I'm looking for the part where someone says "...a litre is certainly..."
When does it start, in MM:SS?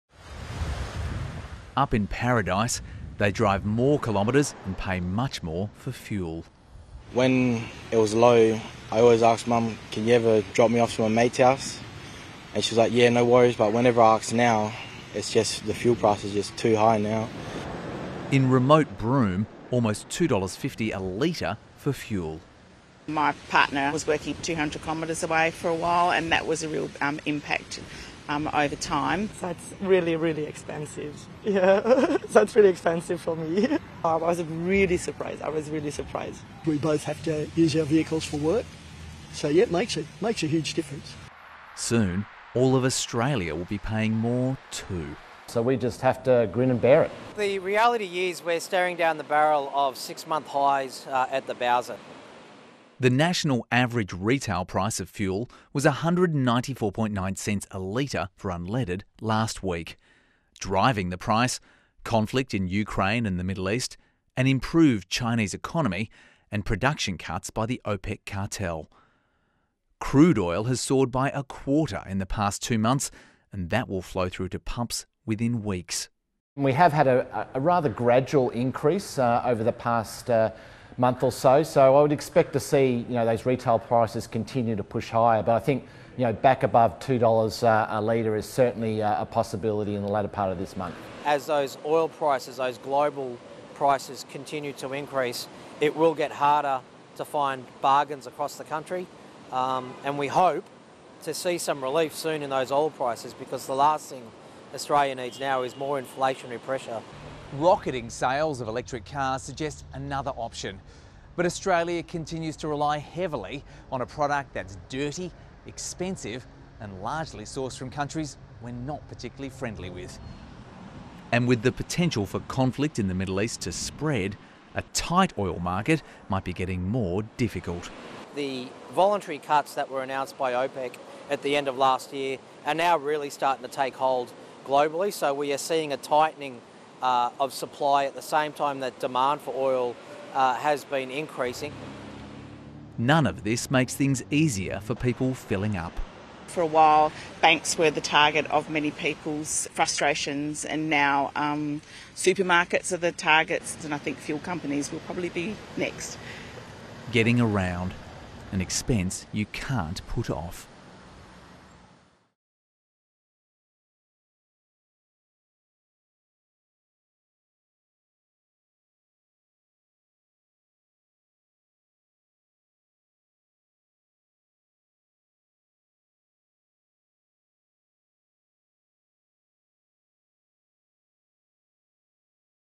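01:27.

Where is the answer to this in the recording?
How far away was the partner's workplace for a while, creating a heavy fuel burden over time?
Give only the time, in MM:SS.
00:24.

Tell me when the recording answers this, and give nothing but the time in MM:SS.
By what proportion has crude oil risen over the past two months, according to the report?
01:11.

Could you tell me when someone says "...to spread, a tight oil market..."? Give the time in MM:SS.
02:03.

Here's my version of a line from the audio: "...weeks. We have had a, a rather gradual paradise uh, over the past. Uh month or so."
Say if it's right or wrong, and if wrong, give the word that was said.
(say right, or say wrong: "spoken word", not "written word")
wrong: "increase", not "paradise".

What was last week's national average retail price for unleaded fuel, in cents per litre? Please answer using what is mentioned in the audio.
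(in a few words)
194.9 cents.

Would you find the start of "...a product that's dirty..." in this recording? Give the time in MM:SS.
01:53.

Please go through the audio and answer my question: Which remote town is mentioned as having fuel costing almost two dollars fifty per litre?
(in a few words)
Broome.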